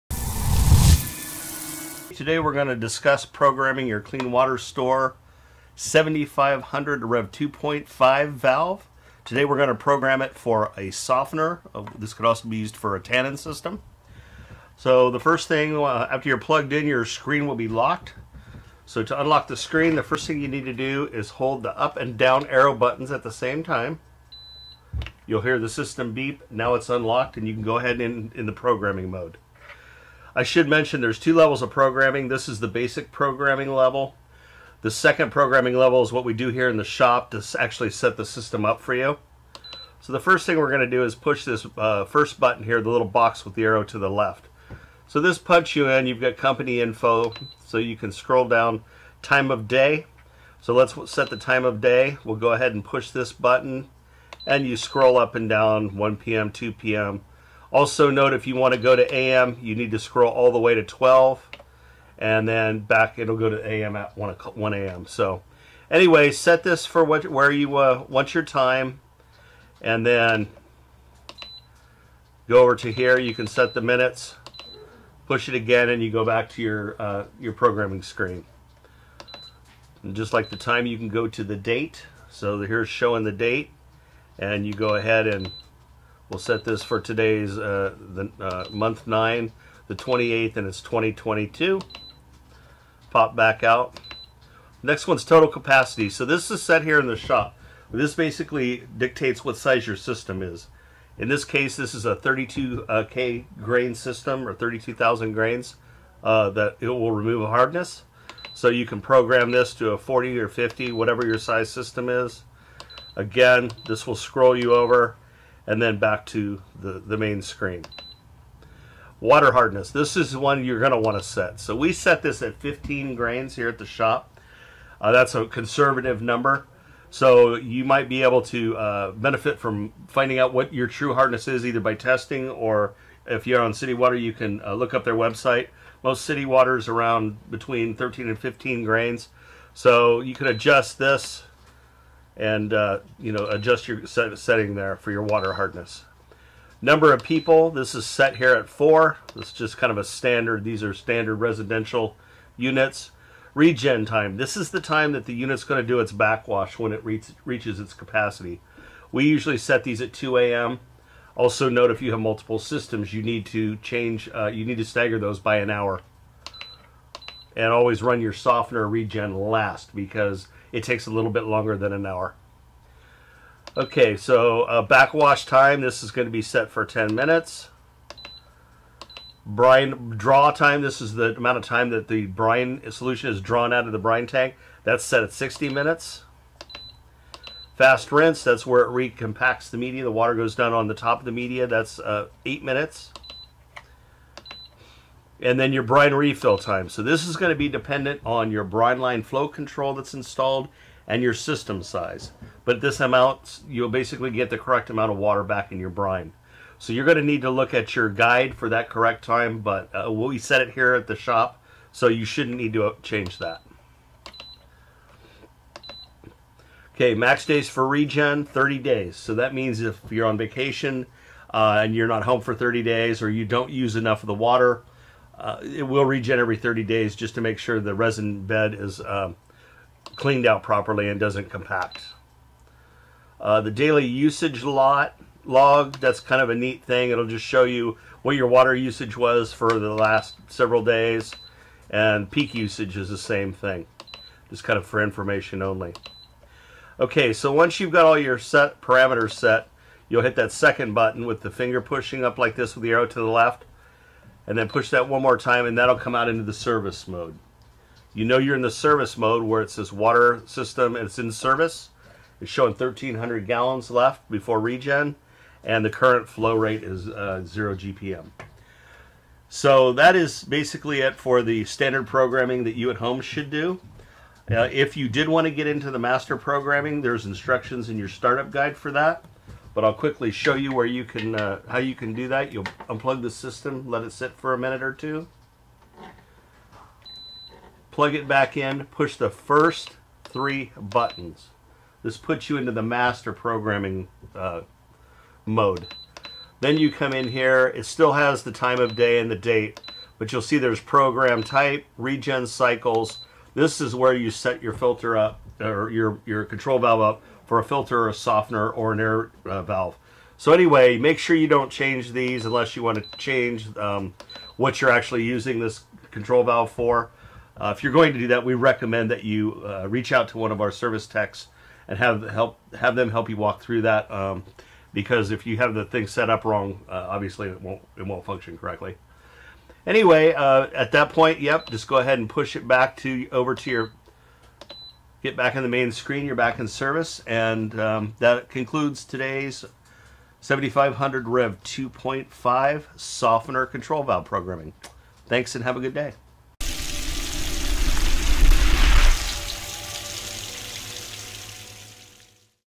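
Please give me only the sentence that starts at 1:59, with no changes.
This is one you're going to want to set.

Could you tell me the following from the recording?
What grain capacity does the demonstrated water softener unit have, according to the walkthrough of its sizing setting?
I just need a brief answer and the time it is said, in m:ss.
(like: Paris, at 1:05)
32,000 grains, at 1:44.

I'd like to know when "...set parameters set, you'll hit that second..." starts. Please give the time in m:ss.
4:08.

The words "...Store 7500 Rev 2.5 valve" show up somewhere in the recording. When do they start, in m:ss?
0:04.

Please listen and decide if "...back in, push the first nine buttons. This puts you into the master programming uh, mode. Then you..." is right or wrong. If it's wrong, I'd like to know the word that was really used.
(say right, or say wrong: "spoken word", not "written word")
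wrong: "three", not "nine".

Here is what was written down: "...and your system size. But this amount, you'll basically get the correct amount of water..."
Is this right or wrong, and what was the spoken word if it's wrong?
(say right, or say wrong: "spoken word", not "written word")
right.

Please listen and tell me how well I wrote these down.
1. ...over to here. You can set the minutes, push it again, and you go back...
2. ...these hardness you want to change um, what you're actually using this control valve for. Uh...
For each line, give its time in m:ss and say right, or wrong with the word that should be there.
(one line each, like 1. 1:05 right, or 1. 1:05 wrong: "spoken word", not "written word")
1. 1:12 right
2. 5:12 wrong: "unless", not "hardness".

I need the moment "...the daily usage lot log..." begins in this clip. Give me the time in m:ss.
3:53.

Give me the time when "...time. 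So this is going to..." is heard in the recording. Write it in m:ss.
3:16.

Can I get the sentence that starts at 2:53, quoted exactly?
Okay, so uh, backwash time, this is going to be set for 10 minutes.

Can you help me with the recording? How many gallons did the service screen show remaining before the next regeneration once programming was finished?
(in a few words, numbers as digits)
1,300 gallons.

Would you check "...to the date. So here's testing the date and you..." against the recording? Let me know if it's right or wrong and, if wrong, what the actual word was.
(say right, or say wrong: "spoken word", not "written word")
wrong: "showing", not "testing".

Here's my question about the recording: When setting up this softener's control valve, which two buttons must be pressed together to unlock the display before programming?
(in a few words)
Up and down arrow buttons.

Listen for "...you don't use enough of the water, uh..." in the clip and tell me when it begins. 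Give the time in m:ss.
3:43.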